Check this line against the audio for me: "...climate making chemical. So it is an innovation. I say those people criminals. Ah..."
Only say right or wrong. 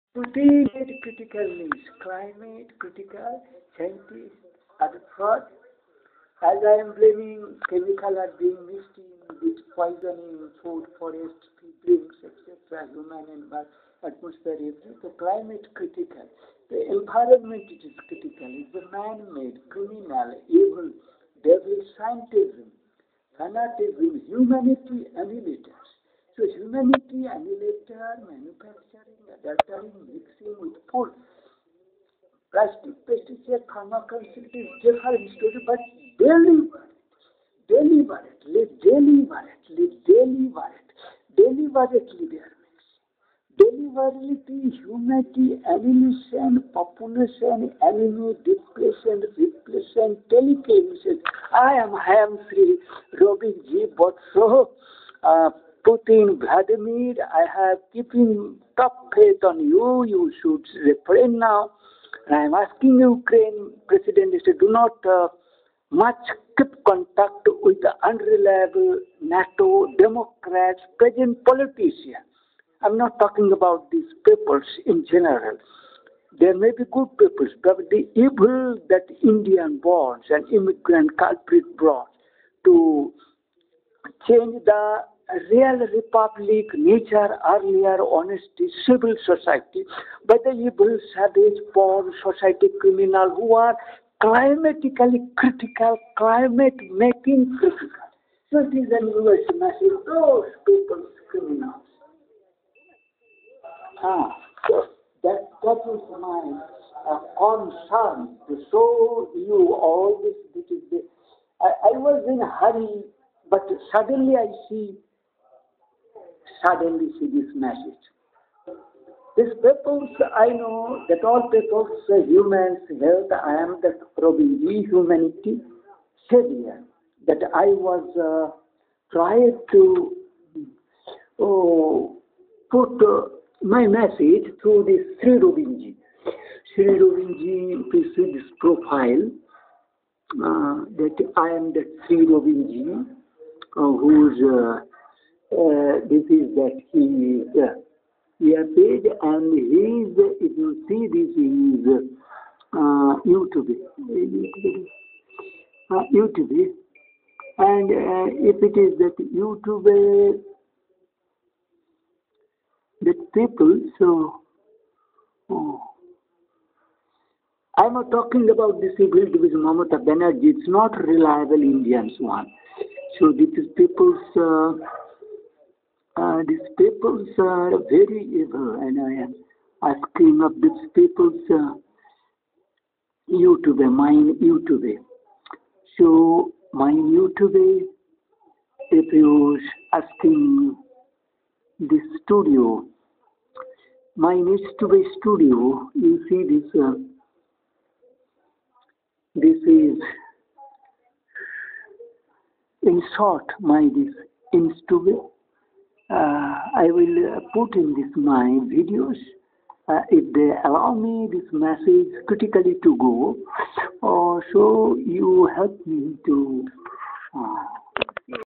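wrong.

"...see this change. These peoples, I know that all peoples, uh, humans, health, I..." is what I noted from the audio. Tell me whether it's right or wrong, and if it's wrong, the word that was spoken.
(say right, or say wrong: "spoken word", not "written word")
wrong: "message", not "change".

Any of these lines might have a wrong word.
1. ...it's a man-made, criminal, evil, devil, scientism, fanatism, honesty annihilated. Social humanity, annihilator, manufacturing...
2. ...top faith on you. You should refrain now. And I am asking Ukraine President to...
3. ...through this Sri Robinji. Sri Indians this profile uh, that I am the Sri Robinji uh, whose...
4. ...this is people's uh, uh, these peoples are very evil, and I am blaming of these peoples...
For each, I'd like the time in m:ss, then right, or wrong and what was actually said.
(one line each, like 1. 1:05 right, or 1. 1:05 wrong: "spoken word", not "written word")
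1. 0:18 wrong: "humanity", not "honesty"
2. 0:58 right
3. 2:14 wrong: "Robinji", not "Indians"
4. 2:53 wrong: "asking", not "blaming".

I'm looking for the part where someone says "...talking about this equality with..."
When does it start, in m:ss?
2:48.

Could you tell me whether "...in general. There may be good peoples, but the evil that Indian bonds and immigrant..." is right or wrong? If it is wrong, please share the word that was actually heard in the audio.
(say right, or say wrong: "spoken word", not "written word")
right.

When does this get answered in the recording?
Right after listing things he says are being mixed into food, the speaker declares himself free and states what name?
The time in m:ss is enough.
0:53.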